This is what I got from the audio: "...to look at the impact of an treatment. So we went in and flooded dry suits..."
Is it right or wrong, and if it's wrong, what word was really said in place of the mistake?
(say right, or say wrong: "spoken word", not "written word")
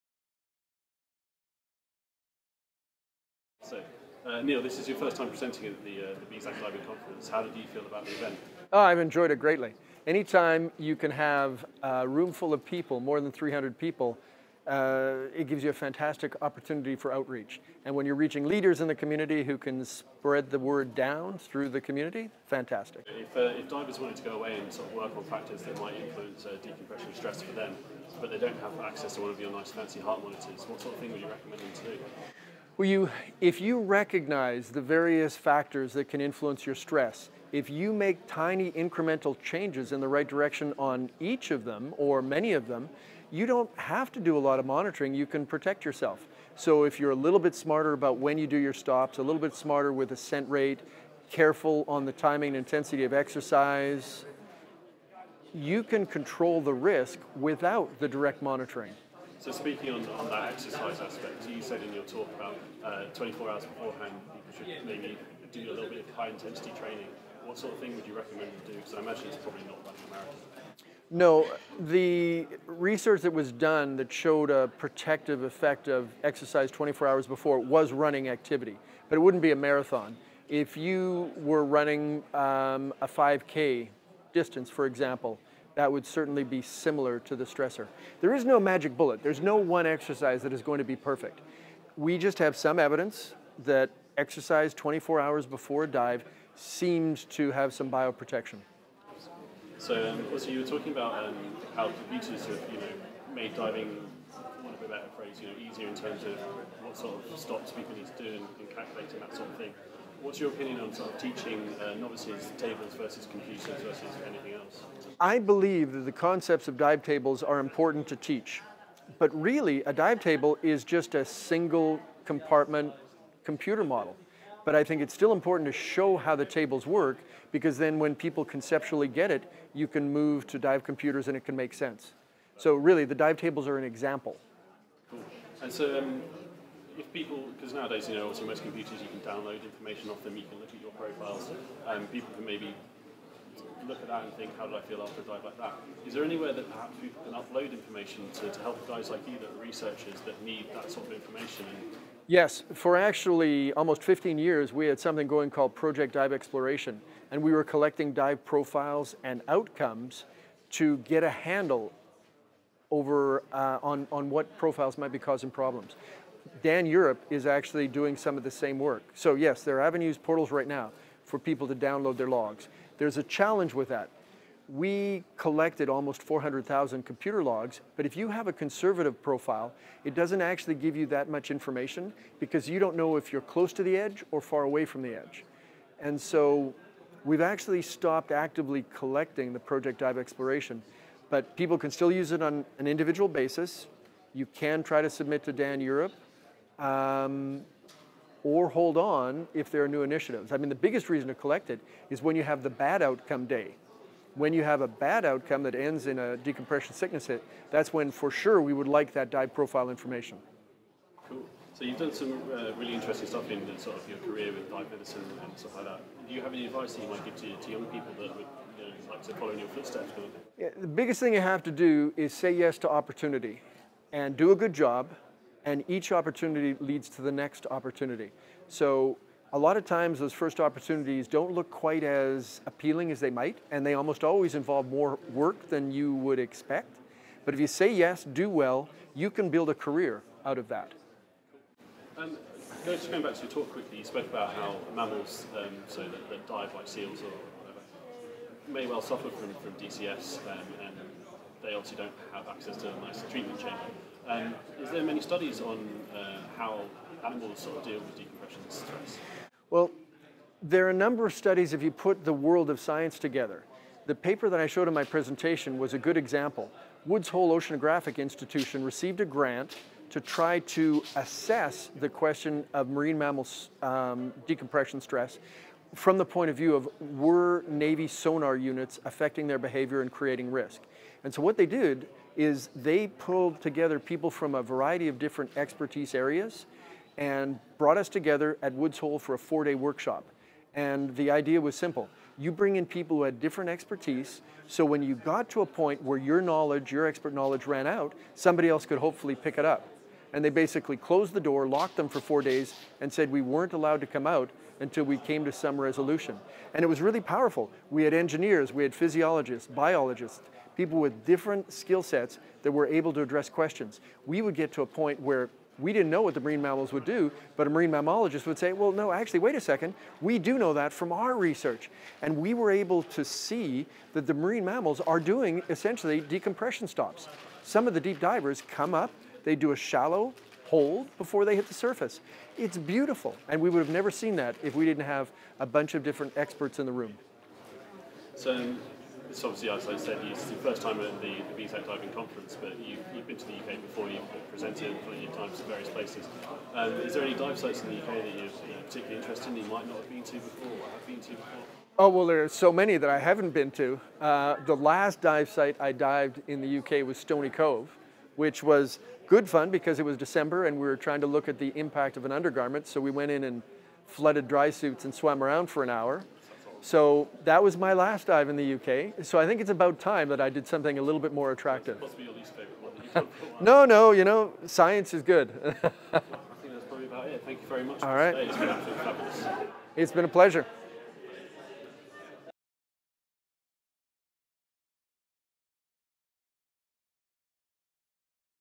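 wrong: "undergarment", not "treatment".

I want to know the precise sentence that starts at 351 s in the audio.
Oh, well, there are so many that I haven't been to.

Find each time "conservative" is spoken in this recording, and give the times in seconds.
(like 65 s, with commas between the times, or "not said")
178 s.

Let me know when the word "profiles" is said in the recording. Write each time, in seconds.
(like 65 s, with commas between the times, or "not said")
140 s, 158 s, 164 s, 179 s, 209 s.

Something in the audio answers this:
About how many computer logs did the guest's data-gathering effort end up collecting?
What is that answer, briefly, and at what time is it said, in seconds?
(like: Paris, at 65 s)
400,000, at 175 s.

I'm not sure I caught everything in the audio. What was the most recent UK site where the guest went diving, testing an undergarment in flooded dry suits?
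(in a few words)
Stony Cove.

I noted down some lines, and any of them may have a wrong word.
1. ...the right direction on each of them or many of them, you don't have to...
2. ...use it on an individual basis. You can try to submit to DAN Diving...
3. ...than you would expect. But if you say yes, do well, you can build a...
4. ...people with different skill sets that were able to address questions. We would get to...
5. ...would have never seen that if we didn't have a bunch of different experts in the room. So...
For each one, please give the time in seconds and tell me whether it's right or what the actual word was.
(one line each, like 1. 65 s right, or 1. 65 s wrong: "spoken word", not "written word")
1. 39 s right
2. 192 s wrong: "Europe", not "Diving"
3. 235 s right
4. 310 s right
5. 333 s right.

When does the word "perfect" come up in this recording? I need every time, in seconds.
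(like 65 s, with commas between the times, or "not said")
90 s.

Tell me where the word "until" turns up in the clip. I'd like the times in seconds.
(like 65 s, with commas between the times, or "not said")
304 s.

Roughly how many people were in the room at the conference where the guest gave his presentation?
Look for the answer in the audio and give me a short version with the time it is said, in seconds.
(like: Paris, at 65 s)
300, at 12 s.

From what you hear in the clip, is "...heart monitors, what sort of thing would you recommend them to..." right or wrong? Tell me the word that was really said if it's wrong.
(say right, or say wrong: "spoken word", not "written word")
right.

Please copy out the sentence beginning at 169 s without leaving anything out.
So yes, there are avenues, portals right now for people to download their logs.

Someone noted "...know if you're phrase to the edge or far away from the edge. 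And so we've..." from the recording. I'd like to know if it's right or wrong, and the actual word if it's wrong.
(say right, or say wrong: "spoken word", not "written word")
wrong: "close", not "phrase".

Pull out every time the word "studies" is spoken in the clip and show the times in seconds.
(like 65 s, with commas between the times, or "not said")
255 s, 261 s.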